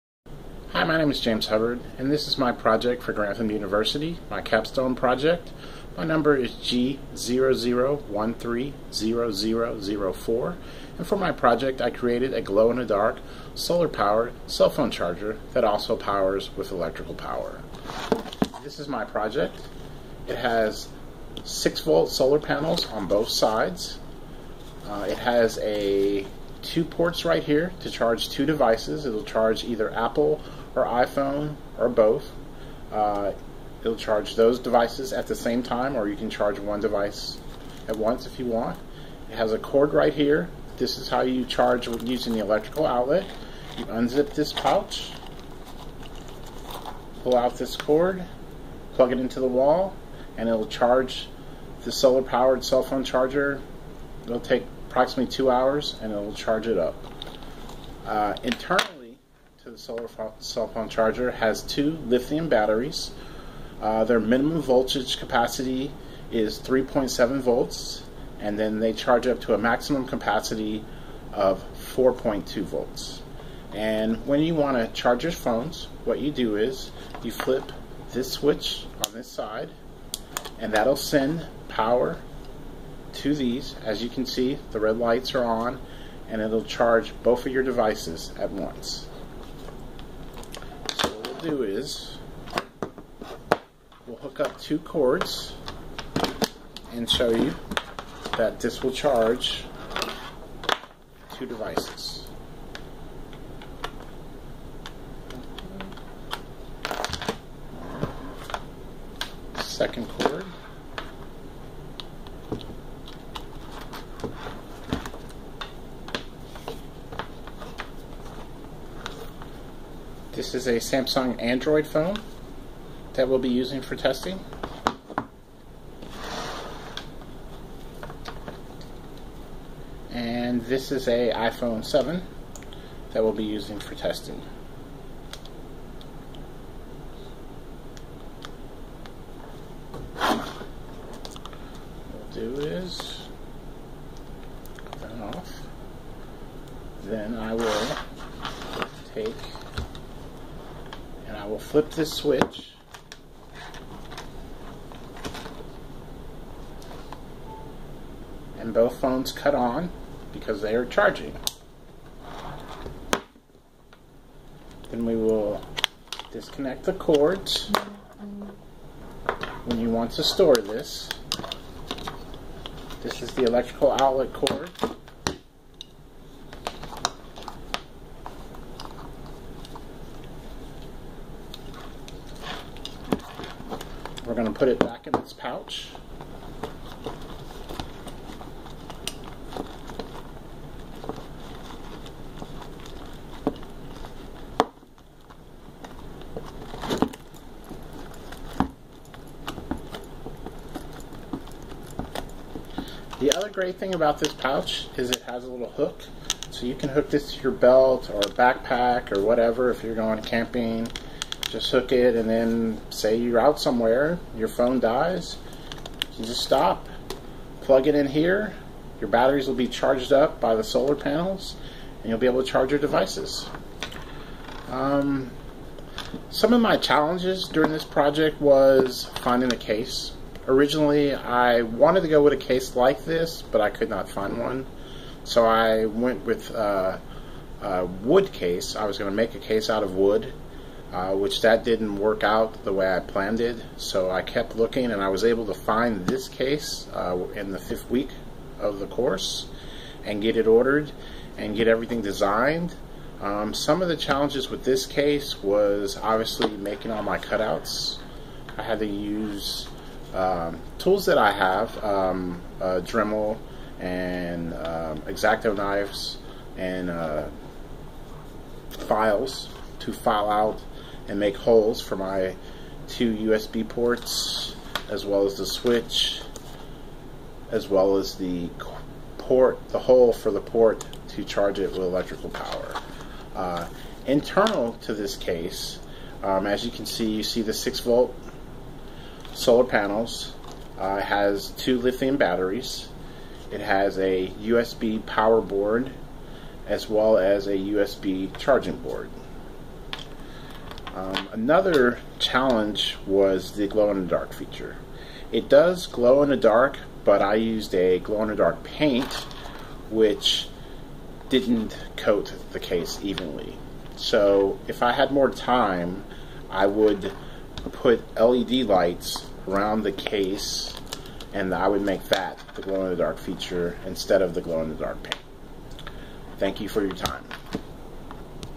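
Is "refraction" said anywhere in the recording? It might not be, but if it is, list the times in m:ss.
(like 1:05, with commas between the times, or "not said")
not said.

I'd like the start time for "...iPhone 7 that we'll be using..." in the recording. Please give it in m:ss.
2:11.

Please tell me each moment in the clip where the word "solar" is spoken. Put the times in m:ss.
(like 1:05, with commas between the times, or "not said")
0:13, 0:22, 0:51, 0:59, 3:40, 4:49.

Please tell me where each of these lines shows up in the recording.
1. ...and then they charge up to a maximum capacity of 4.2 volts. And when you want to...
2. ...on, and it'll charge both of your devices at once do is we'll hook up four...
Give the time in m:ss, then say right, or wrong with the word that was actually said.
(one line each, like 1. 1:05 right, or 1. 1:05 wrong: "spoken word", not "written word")
1. 1:08 right
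2. 1:25 wrong: "two", not "four".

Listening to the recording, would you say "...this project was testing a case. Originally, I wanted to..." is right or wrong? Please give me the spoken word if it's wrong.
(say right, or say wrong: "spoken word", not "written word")
wrong: "finding", not "testing".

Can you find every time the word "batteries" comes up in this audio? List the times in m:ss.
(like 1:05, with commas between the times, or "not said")
1:02, 3:39, 4:52.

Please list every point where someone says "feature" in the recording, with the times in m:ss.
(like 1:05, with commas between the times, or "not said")
5:04, 5:23.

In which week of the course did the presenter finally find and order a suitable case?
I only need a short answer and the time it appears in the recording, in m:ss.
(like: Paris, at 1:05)
Fifth week, at 4:07.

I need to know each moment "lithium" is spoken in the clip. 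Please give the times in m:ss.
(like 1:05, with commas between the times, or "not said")
1:02, 4:51.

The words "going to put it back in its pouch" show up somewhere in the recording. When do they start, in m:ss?
3:04.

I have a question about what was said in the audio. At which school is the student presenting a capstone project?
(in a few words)
Grantham University.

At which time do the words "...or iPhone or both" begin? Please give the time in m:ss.
0:30.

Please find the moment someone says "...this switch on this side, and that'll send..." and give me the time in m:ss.
1:18.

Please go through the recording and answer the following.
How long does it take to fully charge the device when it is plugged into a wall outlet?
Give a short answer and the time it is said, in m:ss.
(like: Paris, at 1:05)
2 hours, at 0:55.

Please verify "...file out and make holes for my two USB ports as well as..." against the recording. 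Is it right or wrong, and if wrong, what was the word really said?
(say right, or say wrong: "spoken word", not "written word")
right.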